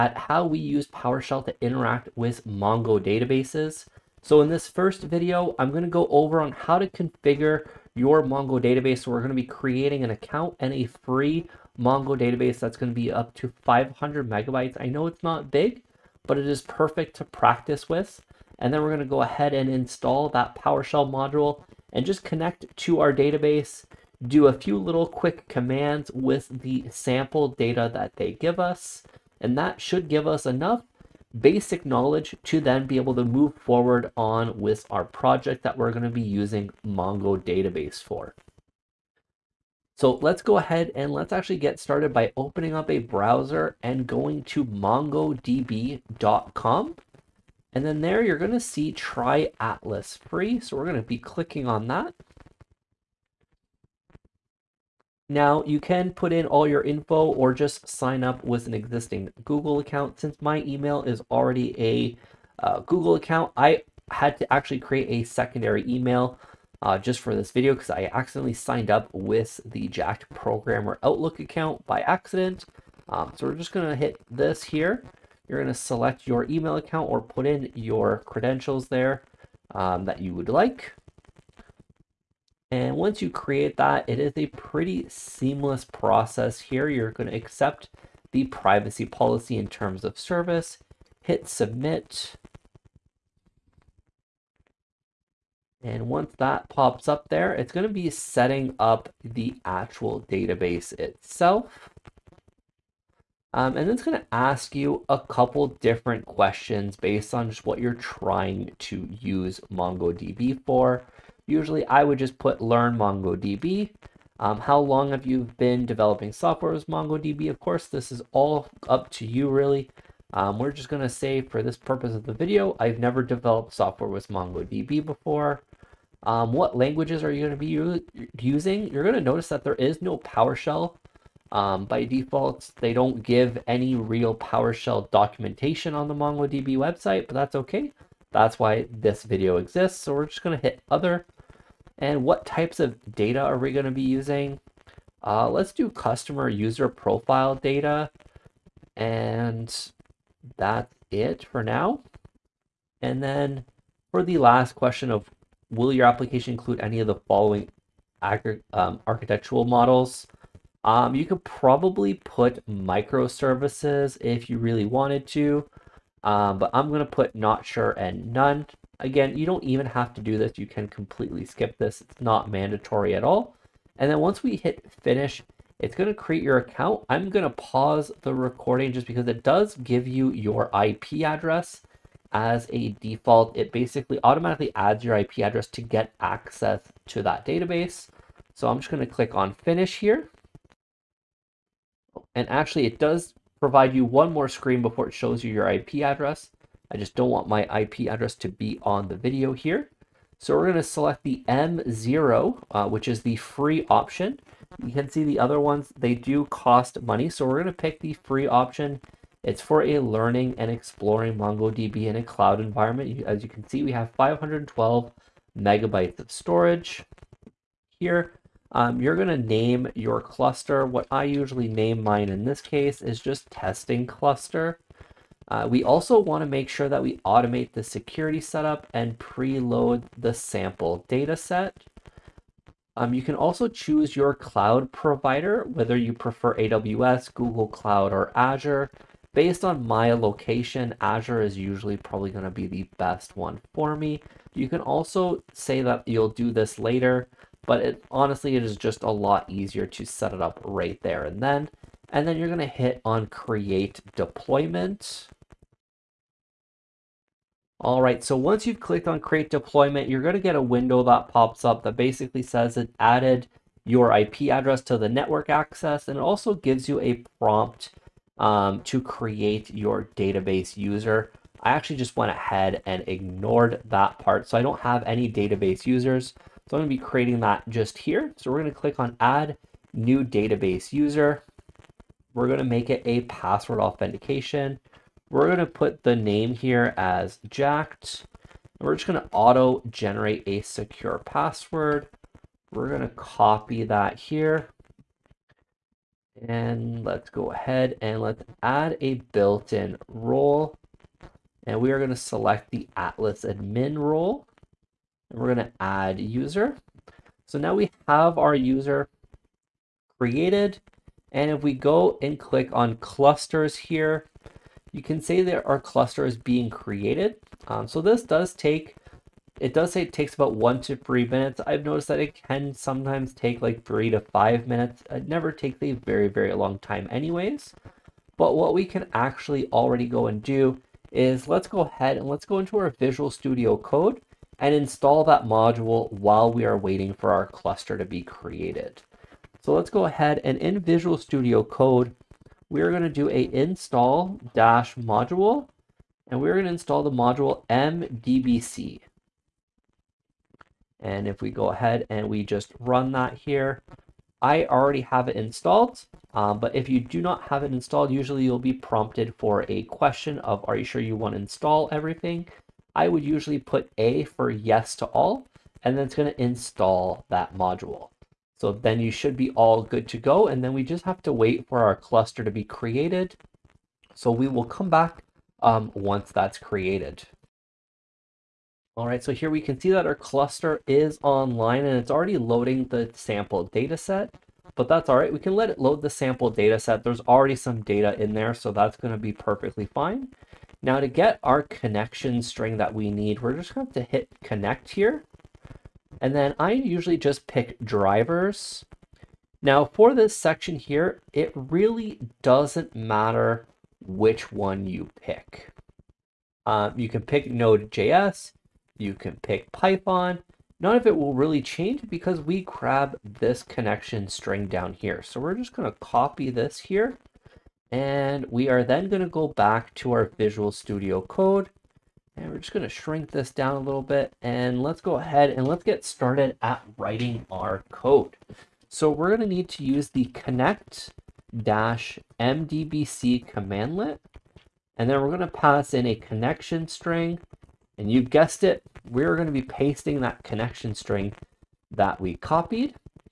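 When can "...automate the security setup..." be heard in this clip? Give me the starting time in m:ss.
3:47.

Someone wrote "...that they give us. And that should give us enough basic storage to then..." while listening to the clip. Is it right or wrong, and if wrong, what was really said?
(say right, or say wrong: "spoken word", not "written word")
wrong: "knowledge", not "storage".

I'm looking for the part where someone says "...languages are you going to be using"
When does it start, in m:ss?
2:06.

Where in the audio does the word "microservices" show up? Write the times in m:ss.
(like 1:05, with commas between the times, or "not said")
2:42.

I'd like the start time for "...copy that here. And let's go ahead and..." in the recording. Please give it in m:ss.
4:53.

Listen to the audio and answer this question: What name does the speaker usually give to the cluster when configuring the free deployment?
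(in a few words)
testing cluster.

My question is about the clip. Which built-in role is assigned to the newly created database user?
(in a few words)
Atlas admin.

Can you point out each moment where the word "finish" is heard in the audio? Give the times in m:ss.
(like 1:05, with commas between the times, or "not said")
2:55, 3:09.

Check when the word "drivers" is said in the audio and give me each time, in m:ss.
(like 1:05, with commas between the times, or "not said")
6:37.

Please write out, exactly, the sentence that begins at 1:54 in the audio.
Um, how long have you been developing software with MongoDB?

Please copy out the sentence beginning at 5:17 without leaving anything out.
Um, so this does take, it does say it takes about one to three minutes.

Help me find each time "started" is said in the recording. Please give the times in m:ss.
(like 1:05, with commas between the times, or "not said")
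0:41, 7:06.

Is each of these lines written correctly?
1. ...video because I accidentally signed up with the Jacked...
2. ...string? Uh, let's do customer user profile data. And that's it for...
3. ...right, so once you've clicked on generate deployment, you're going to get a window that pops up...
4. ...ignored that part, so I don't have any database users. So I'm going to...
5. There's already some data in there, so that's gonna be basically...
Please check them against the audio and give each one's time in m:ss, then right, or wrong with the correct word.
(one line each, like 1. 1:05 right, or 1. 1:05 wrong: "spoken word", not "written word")
1. 1:07 right
2. 2:24 wrong: "using", not "string"
3. 4:18 wrong: "create", not "generate"
4. 4:33 right
5. 6:27 wrong: "perfectly", not "basically".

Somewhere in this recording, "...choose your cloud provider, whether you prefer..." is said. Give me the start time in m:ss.
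3:53.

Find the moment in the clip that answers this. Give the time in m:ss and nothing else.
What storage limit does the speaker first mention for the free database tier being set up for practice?
0:13.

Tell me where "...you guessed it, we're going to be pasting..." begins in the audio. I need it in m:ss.
7:18.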